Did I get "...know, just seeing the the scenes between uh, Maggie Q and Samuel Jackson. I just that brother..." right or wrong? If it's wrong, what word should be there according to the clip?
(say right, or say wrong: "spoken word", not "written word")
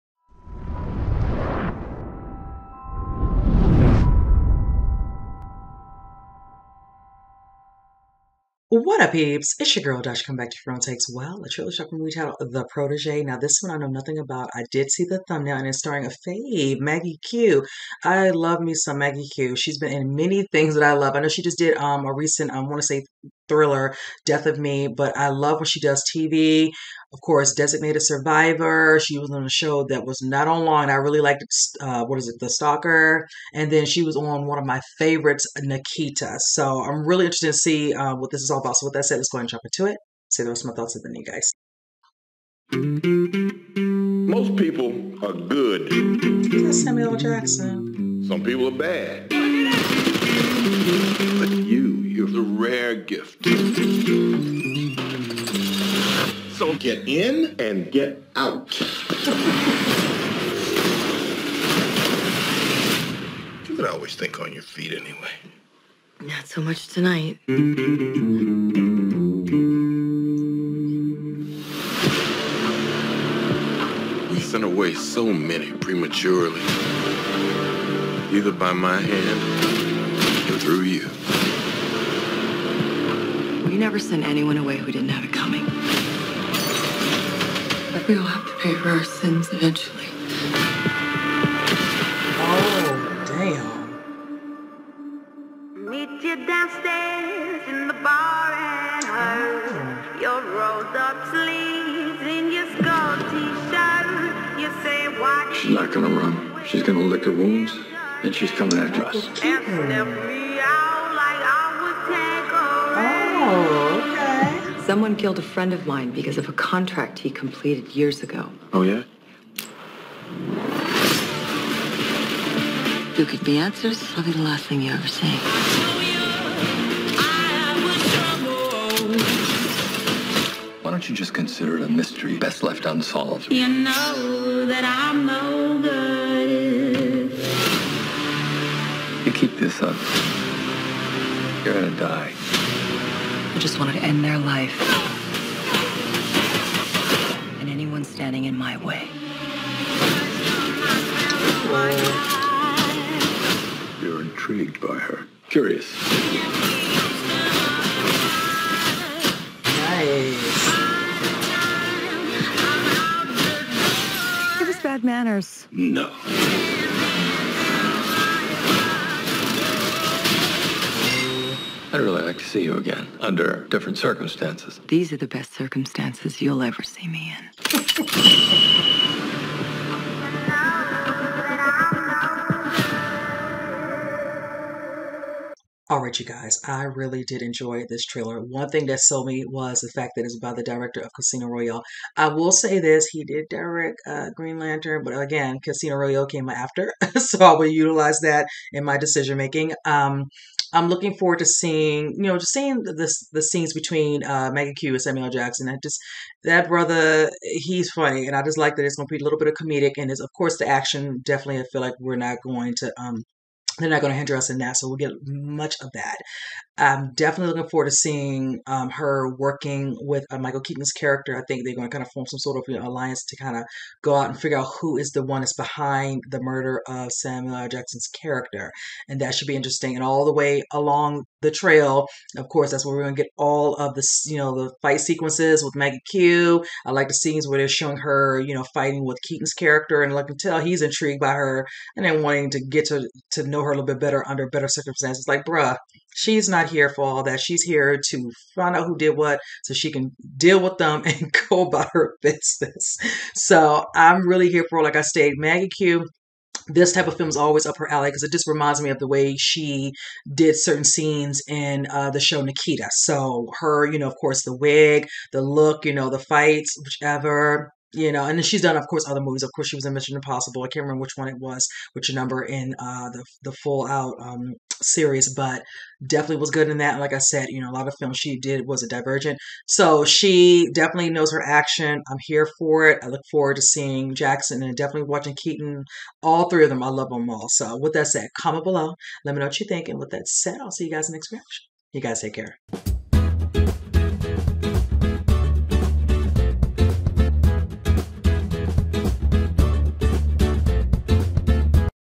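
right.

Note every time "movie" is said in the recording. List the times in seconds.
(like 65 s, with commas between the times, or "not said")
11 s, 269 s.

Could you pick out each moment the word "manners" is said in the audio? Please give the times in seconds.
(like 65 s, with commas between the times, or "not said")
165 s.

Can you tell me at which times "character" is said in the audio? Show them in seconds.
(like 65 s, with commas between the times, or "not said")
220 s, 228 s, 239 s.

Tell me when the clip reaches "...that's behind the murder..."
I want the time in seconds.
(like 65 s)
225 s.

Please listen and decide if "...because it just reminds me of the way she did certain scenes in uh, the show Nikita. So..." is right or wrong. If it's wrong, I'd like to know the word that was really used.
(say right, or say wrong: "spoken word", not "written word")
right.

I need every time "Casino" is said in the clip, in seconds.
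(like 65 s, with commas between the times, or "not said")
191 s, 195 s.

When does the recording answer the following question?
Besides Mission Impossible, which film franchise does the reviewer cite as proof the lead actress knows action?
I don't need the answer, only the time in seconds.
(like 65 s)
278 s.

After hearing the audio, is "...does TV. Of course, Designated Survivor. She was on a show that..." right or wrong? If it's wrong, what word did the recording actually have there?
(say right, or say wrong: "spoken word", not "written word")
right.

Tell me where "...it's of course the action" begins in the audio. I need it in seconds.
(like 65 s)
210 s.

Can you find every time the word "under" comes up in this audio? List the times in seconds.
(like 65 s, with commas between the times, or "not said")
173 s, 244 s.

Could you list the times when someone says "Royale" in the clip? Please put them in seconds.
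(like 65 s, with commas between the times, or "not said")
191 s, 195 s.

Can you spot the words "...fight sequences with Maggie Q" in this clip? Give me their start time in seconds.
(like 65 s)
234 s.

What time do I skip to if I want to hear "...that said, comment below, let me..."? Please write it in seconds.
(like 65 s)
287 s.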